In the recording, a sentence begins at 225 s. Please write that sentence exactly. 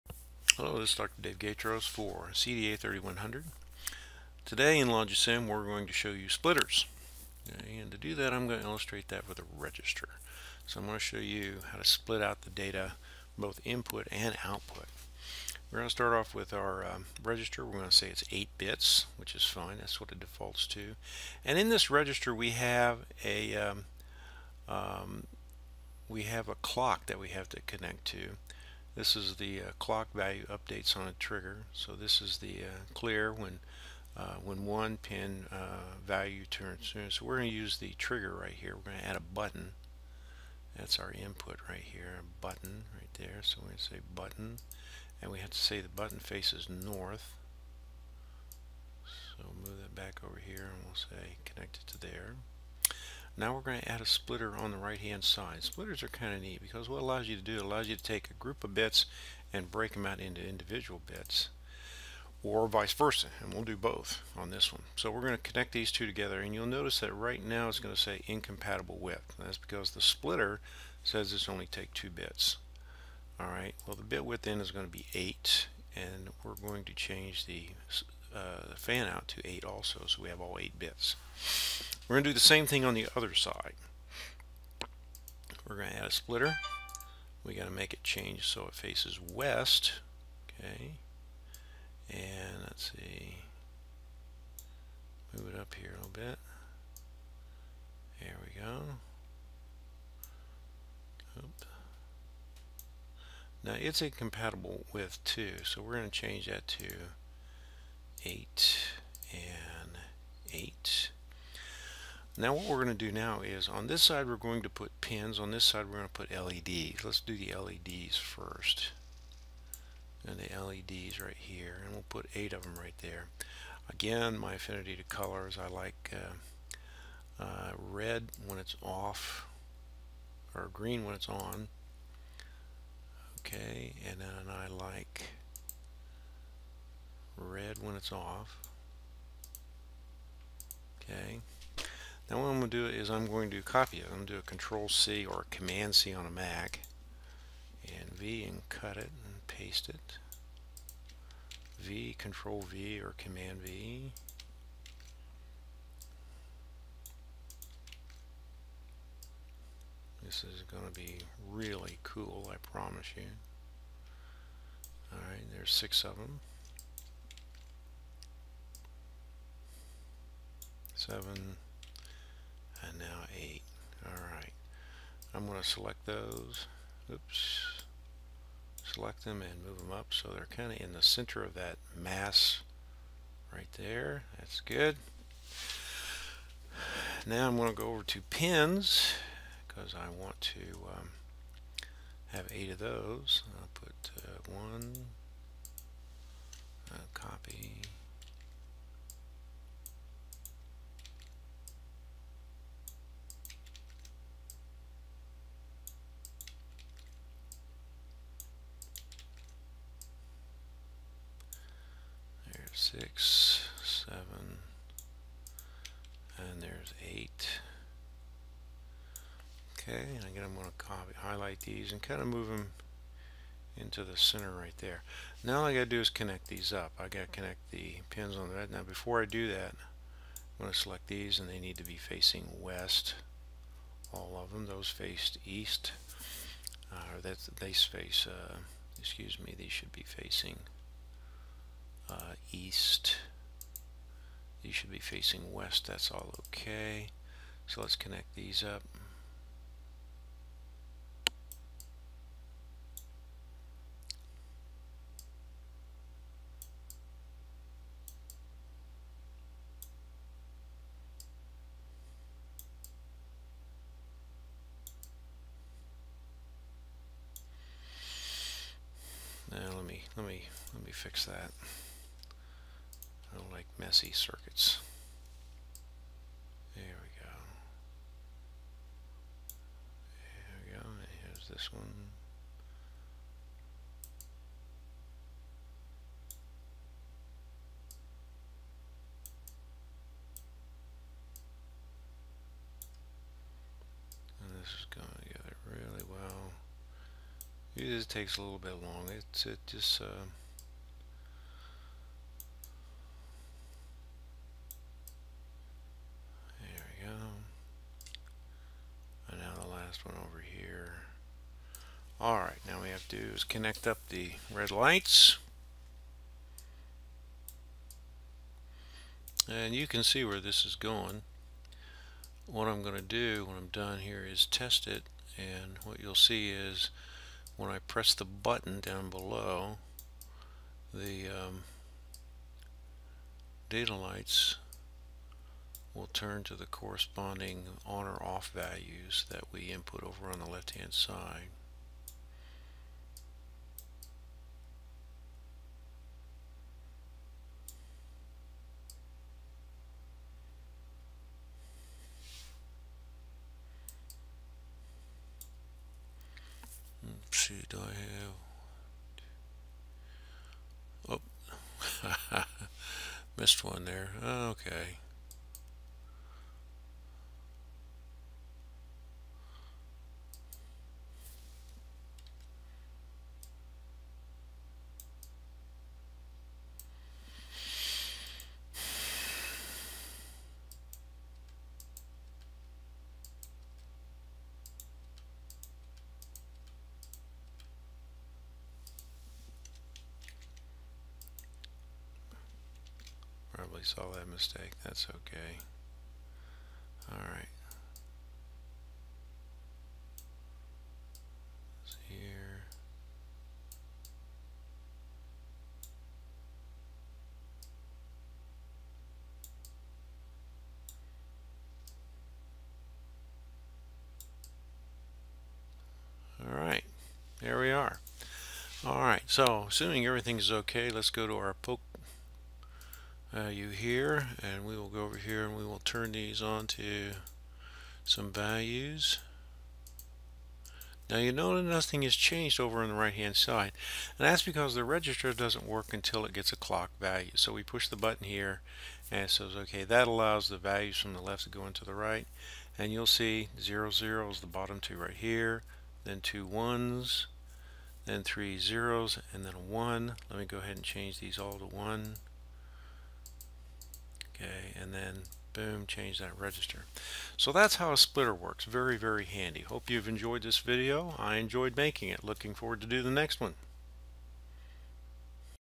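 Now all I got to do is connect these up.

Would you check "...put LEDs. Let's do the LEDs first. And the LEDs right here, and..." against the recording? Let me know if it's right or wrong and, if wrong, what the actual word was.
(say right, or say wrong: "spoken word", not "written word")
right.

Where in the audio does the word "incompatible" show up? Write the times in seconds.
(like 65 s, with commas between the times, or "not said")
68 s, 104 s.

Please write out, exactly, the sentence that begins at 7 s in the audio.
And to do that I'm going to illustrate that with a register.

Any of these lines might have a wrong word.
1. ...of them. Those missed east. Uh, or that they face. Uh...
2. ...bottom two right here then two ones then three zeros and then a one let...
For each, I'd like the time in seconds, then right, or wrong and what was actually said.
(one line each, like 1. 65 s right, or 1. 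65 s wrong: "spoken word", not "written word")
1. 234 s wrong: "faced", not "missed"
2. 444 s right.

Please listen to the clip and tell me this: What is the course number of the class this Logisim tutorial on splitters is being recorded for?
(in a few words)
CDA 3100.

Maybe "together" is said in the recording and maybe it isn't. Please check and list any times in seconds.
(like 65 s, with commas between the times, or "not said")
66 s, 295 s.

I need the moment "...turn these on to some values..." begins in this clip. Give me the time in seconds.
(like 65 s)
425 s.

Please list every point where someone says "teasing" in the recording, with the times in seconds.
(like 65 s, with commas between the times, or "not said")
not said.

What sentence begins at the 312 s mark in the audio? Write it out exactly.
Alright, now we have to do is connect up the red lights.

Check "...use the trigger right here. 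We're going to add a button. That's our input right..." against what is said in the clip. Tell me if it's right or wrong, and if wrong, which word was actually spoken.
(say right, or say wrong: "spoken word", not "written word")
right.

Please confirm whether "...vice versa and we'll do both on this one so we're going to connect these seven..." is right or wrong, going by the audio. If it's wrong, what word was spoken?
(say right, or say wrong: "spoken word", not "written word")
wrong: "two", not "seven".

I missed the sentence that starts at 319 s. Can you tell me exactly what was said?
And you can see where this is going.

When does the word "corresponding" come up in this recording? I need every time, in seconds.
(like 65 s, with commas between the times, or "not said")
336 s.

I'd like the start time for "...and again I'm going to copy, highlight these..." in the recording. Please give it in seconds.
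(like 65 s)
220 s.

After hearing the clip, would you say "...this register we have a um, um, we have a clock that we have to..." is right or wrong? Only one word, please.
right.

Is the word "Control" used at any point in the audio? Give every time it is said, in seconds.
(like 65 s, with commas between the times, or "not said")
144 s, 152 s.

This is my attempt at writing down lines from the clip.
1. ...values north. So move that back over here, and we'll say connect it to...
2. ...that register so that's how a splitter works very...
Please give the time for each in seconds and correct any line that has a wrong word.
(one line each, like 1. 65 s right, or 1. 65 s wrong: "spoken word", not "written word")
1. 46 s wrong: "faces", not "values"
2. 456 s right.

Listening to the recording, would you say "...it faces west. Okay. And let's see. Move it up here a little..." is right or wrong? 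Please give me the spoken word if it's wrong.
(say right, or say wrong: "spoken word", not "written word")
right.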